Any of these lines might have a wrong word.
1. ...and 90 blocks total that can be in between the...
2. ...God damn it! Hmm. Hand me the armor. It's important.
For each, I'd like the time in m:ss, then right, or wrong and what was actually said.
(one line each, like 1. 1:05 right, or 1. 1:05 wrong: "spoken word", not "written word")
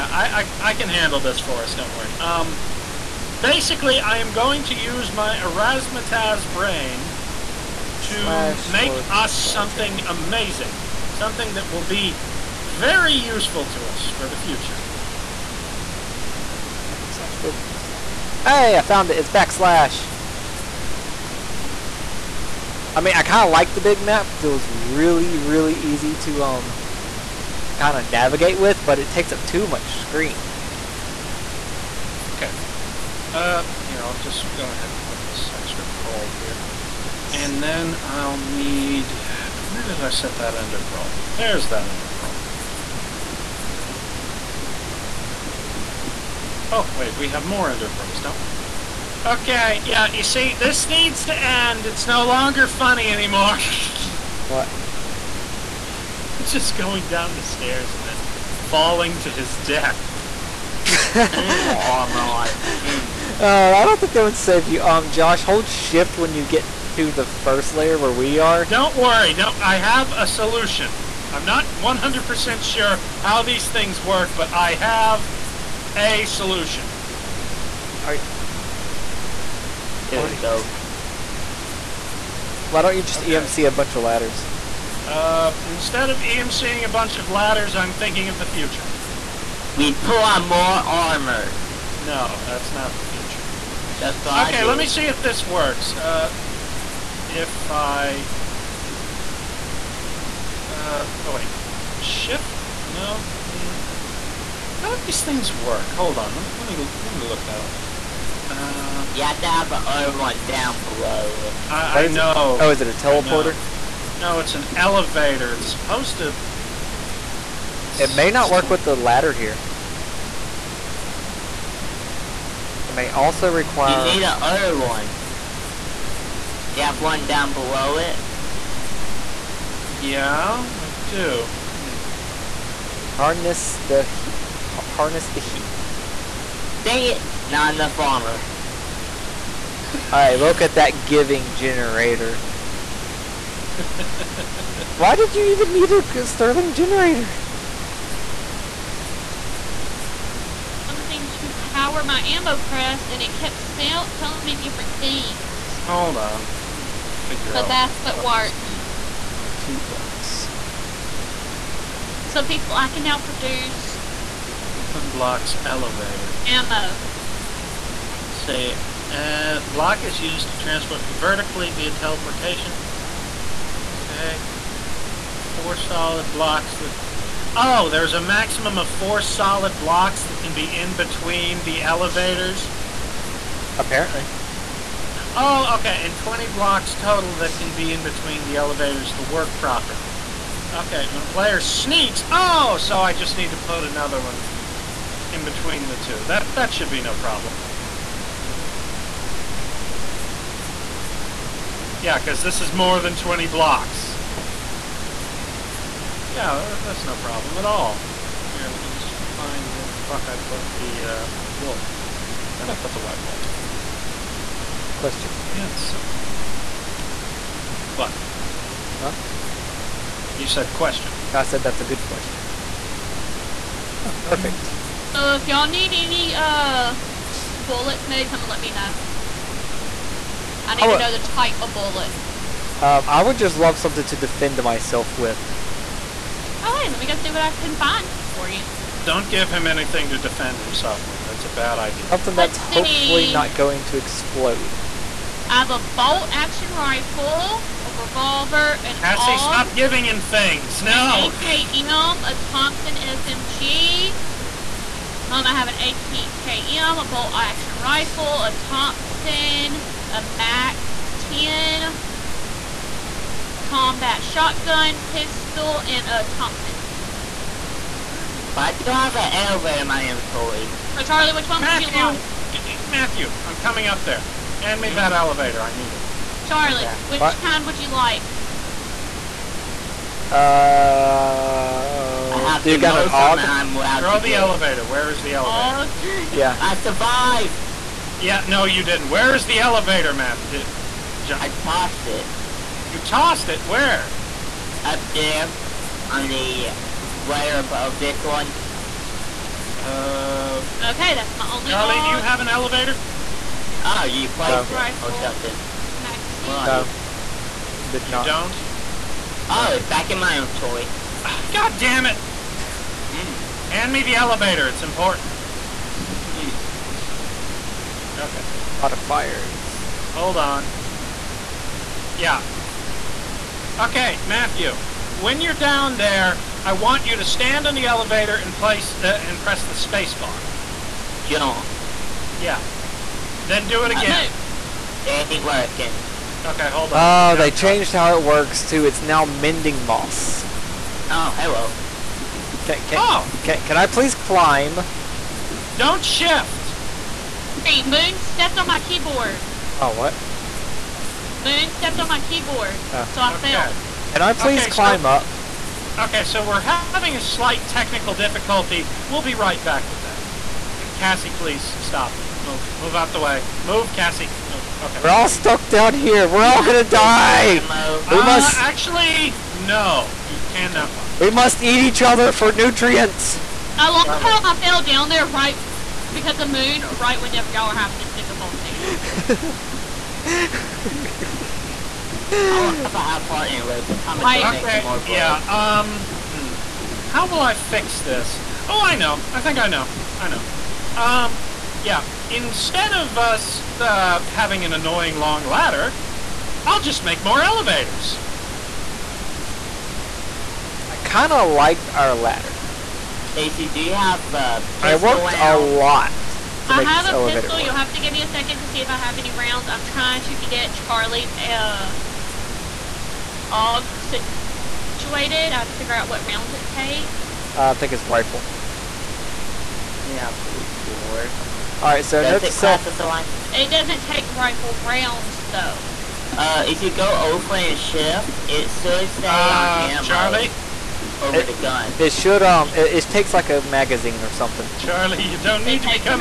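1. 3:06 wrong: "20", not "90"
2. 5:11 wrong: "elevator", not "armor".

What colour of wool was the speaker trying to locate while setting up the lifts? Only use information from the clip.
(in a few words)
White.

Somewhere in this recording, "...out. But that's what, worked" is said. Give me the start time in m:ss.
2:37.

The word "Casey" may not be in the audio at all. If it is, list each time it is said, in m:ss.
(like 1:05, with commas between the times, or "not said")
6:43.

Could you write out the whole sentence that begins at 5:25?
When you're down there, I want you to stand on the elevator and place uh, and press the space bar.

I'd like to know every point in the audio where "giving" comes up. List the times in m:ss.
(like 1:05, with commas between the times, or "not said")
2:21, 4:09.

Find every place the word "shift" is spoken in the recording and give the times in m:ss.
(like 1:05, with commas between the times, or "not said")
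1:05, 1:41, 5:46, 7:07.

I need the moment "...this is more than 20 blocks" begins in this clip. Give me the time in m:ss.
3:22.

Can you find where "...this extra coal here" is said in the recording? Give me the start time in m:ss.
0:35.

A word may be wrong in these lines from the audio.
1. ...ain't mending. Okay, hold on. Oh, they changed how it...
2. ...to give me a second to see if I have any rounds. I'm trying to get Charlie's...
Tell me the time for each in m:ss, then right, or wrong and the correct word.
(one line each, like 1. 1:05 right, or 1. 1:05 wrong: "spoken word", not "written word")
1. 5:35 wrong: "working", not "mending"
2. 6:47 right.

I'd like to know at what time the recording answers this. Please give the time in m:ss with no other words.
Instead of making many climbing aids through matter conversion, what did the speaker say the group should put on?
1:30.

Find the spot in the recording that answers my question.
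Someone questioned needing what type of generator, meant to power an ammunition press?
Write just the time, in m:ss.
2:26.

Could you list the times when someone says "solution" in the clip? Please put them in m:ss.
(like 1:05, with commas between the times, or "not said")
1:10, 1:16.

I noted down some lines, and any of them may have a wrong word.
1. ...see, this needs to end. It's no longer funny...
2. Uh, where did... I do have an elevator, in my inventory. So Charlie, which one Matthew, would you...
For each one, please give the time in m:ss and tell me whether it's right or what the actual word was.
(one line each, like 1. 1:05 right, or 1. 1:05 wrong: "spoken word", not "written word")
1. 0:50 right
2. 4:27 right.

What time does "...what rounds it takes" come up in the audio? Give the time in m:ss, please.
6:56.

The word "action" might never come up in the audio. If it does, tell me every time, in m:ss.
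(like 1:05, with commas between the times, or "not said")
4:06, 4:17.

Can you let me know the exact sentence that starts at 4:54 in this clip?
up there on the layer above this one.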